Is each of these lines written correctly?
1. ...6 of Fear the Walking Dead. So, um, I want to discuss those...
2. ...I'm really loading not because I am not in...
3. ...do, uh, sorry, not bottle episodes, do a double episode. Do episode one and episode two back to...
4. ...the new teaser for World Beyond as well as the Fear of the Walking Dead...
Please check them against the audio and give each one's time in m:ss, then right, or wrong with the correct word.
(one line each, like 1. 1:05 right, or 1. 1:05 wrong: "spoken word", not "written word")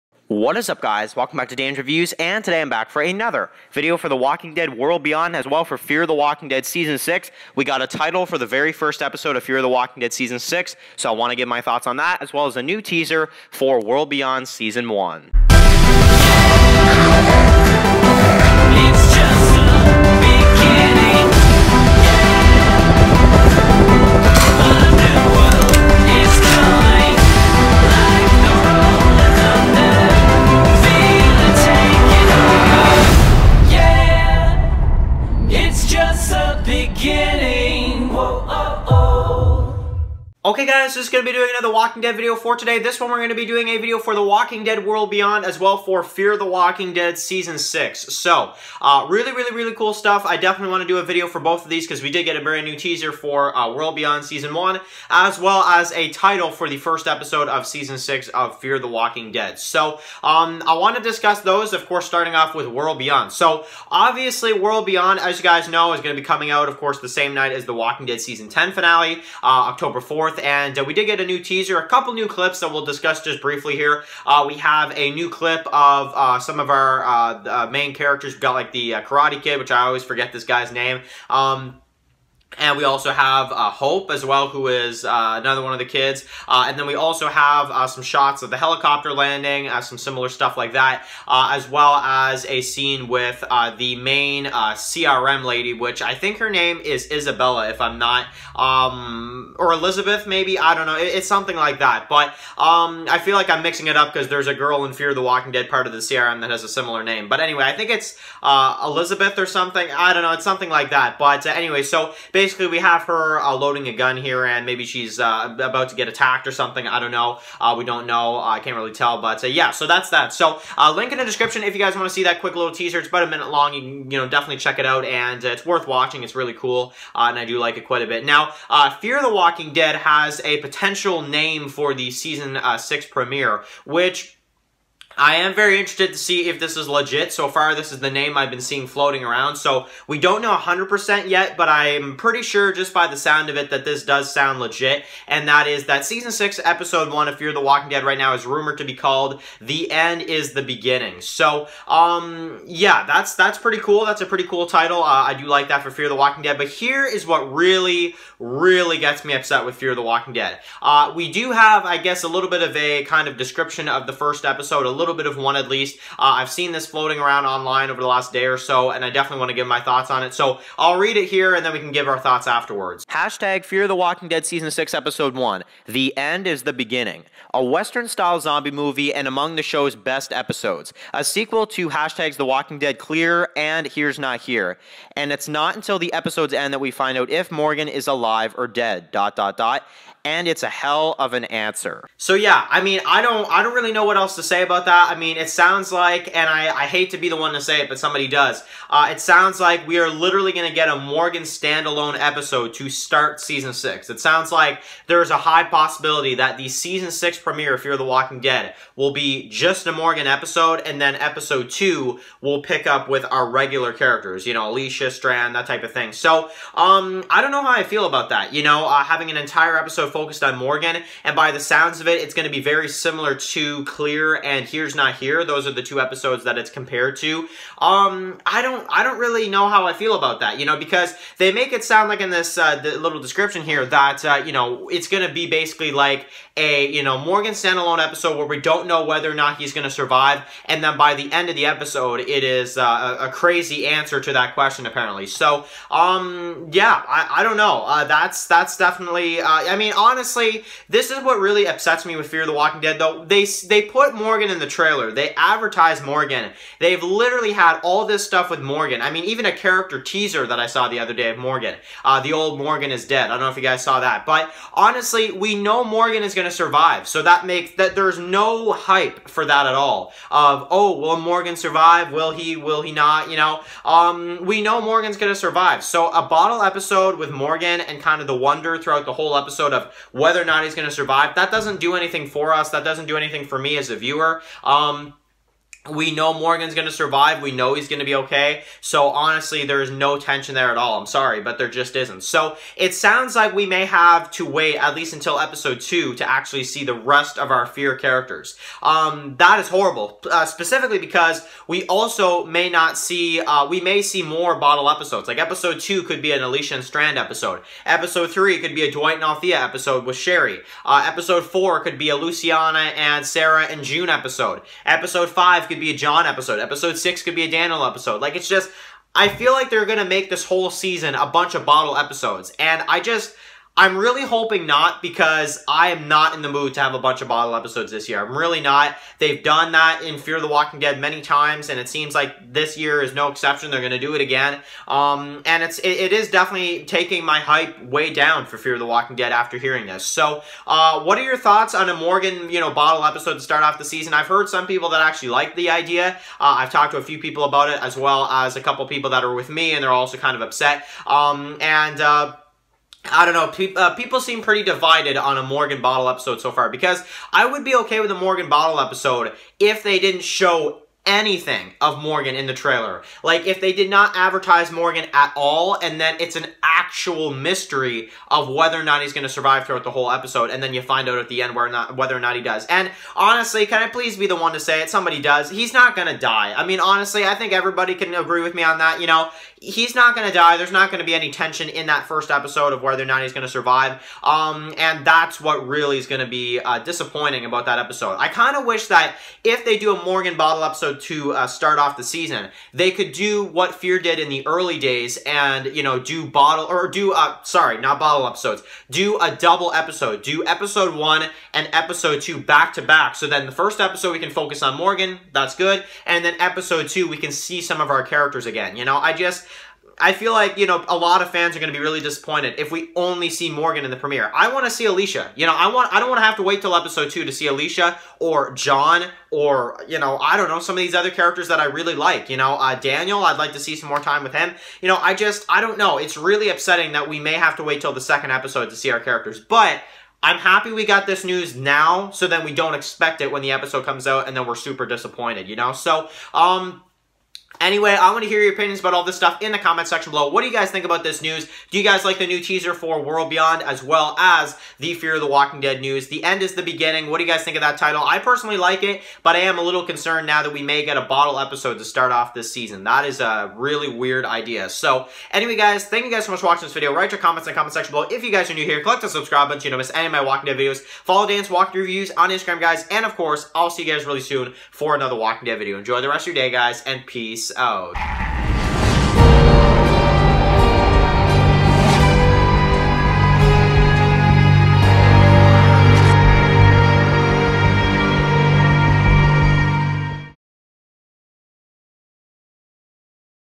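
1. 0:57 right
2. 5:23 wrong: "hoping", not "loading"
3. 6:36 right
4. 7:22 right.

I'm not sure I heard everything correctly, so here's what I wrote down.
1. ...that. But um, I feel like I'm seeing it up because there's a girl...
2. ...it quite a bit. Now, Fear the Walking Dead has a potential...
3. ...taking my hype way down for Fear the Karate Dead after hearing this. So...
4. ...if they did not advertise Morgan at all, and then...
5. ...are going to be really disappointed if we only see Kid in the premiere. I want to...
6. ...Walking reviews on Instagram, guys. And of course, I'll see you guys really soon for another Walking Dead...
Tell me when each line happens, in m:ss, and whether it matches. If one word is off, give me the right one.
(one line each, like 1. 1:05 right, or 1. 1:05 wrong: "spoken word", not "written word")
1. 1:41 wrong: "mixing", not "seeing"
2. 2:07 right
3. 5:36 wrong: "Walking", not "Karate"
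4. 6:03 right
5. 6:51 wrong: "Morgan", not "Kid"
6. 7:41 right.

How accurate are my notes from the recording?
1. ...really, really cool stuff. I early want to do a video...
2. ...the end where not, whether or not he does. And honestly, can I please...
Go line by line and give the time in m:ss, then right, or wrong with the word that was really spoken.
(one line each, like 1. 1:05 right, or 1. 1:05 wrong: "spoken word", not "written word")
1. 0:49 wrong: "definitely", not "early"
2. 6:11 right.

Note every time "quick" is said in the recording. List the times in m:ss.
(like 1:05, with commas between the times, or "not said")
2:02.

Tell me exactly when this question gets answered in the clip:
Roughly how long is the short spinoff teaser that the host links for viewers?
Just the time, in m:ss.
2:03.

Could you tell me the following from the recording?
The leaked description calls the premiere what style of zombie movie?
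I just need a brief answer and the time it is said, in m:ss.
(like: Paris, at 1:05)
Western-style, at 2:57.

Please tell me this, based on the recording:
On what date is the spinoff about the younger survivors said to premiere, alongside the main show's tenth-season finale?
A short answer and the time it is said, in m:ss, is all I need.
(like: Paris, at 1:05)
October 4th, at 1:09.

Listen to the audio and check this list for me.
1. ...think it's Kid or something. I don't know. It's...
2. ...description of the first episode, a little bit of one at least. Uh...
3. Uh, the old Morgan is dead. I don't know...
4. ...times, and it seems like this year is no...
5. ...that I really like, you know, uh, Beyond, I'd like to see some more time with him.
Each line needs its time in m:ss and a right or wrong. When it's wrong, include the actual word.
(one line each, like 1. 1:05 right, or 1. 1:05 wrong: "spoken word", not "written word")
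1. 1:47 wrong: "Elizabeth", not "Kid"
2. 2:43 right
3. 4:22 right
4. 5:31 right
5. 7:01 wrong: "Daniel", not "Beyond".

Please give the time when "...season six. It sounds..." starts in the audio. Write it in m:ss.
3:23.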